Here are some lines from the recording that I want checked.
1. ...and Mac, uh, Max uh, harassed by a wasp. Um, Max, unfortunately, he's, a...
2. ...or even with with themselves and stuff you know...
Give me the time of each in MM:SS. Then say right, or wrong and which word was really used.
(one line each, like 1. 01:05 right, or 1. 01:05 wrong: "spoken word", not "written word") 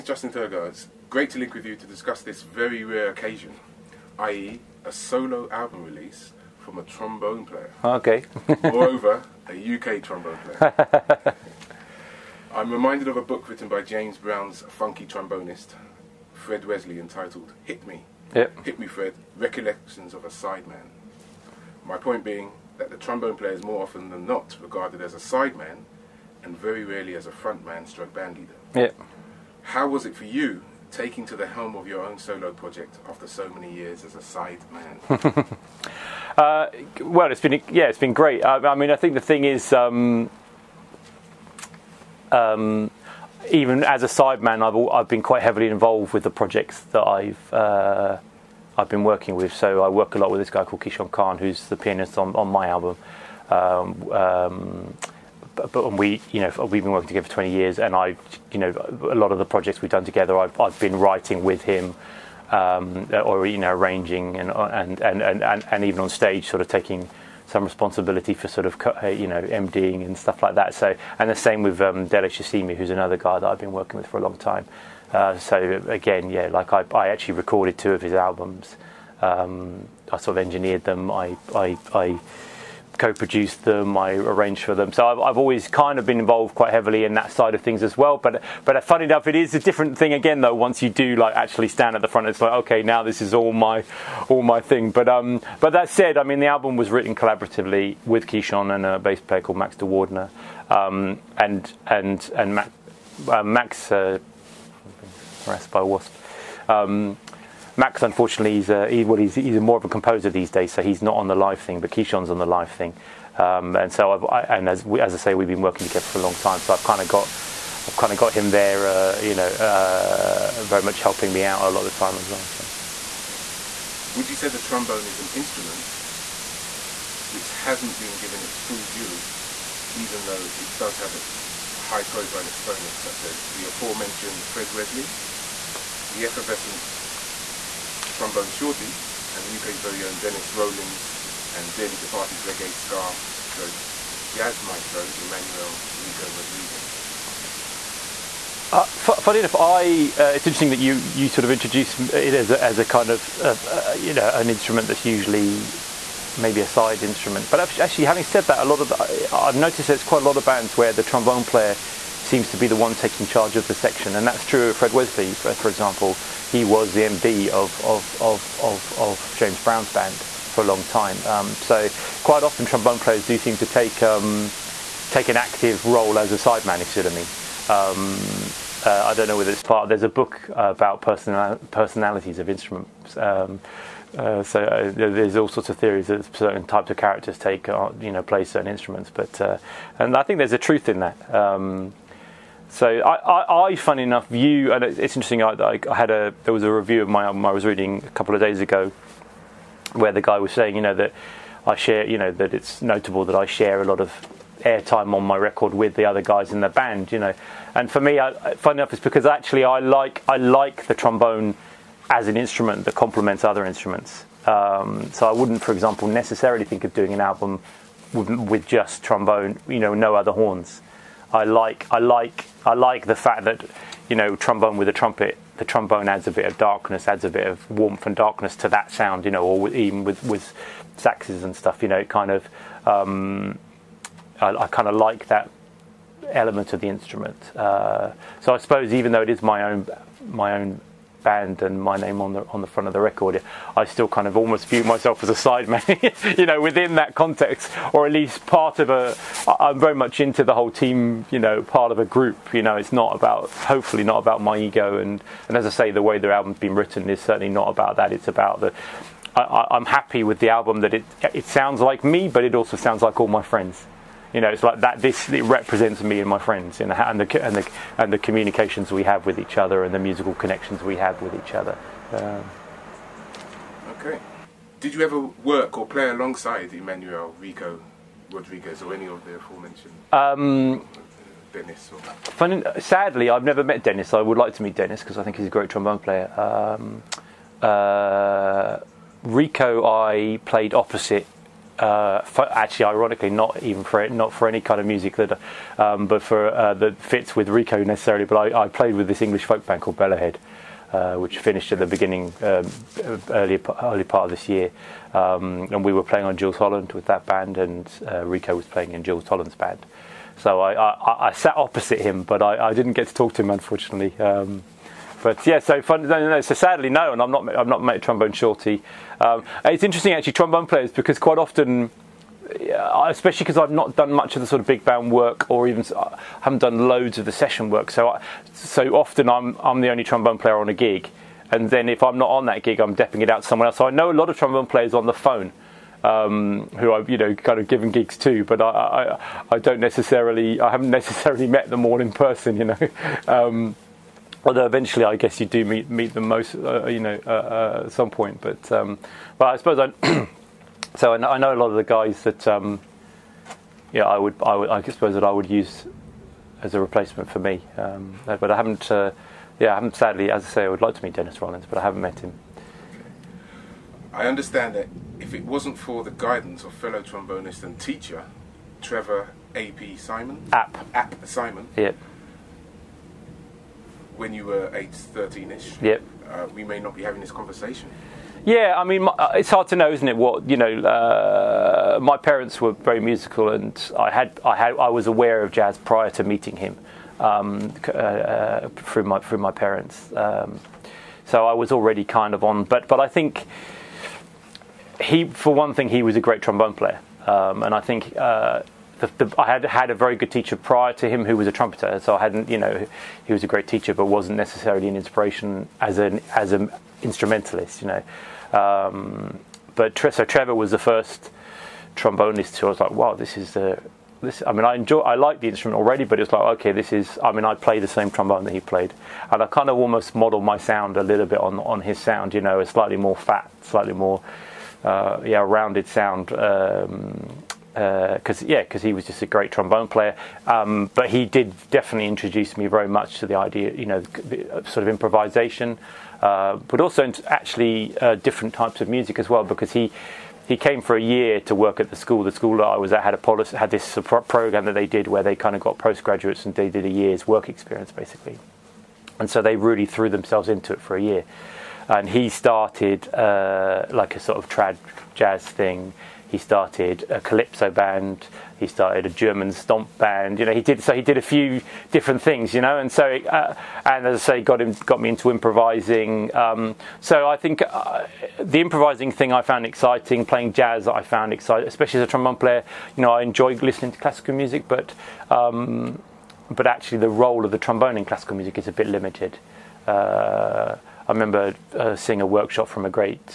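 1. 01:42 right
2. 03:49 wrong: "saxes", not "themselves".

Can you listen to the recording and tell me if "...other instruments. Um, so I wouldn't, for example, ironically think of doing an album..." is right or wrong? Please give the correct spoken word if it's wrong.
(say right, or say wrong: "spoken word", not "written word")
wrong: "necessarily", not "ironically".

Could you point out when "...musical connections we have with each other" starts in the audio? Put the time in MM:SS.
04:29.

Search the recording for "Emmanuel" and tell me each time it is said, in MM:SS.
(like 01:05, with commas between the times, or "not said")
02:25, 04:36.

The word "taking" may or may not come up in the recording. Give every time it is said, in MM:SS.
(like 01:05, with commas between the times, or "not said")
00:30, 01:06, 02:42.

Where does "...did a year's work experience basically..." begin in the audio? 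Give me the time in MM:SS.
07:26.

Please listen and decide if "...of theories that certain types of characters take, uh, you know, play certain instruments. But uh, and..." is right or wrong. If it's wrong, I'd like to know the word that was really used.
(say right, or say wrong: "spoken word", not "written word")
right.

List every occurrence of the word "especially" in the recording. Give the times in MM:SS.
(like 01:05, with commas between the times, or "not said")
05:22, 07:51.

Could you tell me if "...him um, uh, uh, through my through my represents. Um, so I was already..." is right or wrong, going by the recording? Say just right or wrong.
wrong.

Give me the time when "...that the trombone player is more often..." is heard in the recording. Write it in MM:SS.
00:22.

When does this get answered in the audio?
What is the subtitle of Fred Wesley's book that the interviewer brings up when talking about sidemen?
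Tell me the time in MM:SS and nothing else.
00:19.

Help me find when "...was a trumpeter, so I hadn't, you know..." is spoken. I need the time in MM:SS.
06:41.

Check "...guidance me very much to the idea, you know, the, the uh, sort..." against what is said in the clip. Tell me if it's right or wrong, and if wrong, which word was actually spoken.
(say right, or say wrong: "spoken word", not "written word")
wrong: "introduce", not "guidance".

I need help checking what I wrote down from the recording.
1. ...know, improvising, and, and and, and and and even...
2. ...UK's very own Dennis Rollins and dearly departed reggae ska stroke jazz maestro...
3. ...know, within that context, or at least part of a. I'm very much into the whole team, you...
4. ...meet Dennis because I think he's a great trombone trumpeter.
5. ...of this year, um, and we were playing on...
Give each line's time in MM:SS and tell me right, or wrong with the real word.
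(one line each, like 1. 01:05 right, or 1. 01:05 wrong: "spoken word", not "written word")
1. 01:03 wrong: "arranging", not "improvising"
2. 02:19 right
3. 04:06 right
4. 04:44 wrong: "player", not "trumpeter"
5. 05:04 right.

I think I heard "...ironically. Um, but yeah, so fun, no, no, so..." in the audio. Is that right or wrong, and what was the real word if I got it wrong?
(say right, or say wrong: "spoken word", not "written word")
wrong: "unfortunately", not "ironically".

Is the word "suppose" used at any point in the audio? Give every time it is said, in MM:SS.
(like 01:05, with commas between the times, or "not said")
03:58, 05:49, 05:54.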